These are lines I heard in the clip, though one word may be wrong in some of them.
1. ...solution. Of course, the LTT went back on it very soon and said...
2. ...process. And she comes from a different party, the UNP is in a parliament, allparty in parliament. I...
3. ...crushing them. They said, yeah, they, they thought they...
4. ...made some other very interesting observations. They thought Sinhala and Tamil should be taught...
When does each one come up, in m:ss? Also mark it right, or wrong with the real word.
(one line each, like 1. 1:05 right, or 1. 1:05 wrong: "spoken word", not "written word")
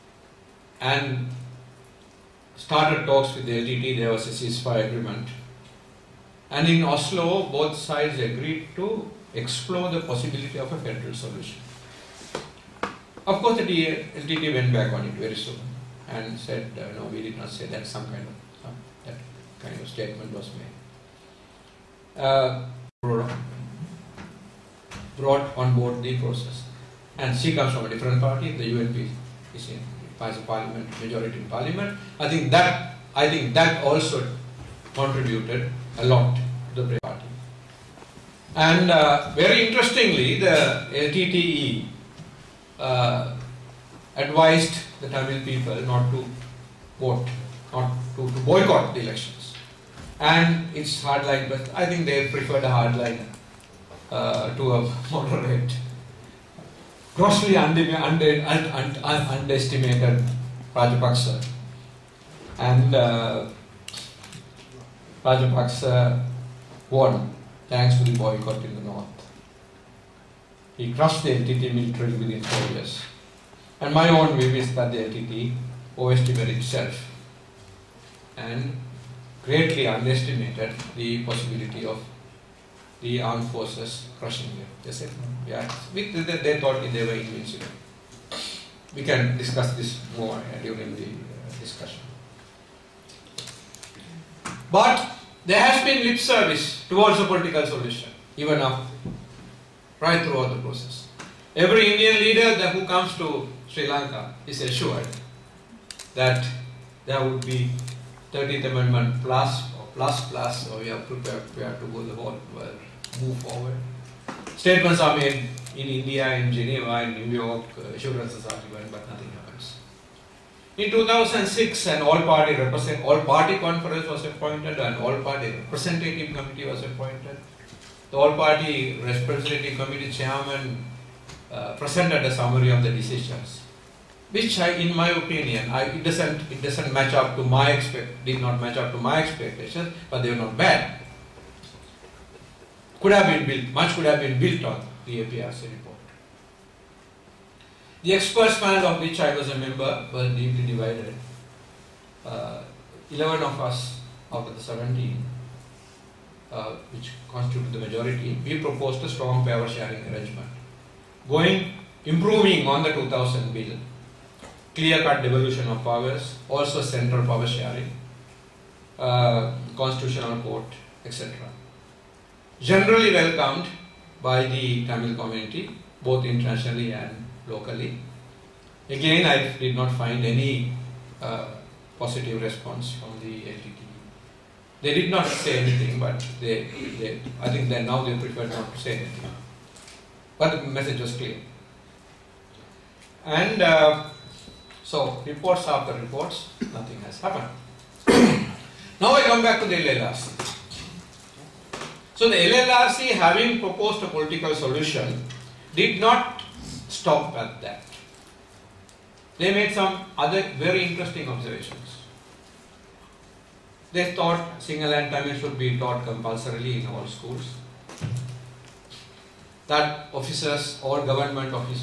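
1. 0:11 right
2. 0:26 wrong: "majority", not "allparty"
3. 1:24 right
4. 3:29 right.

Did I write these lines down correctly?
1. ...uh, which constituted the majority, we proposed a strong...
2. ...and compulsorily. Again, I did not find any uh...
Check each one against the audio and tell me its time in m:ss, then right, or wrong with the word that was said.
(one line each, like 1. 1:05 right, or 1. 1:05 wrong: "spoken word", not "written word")
1. 2:36 right
2. 2:56 wrong: "locally", not "compulsorily".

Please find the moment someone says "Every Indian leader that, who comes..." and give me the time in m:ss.
1:41.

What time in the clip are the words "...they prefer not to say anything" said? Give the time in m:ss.
3:08.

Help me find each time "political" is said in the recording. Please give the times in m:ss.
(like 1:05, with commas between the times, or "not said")
1:37, 3:24.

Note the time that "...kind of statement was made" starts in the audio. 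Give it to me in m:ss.
0:19.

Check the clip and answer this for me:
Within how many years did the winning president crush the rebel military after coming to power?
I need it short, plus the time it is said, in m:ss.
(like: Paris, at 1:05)
4 years, at 1:12.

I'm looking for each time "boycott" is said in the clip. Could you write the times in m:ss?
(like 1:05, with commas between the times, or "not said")
0:48, 1:08.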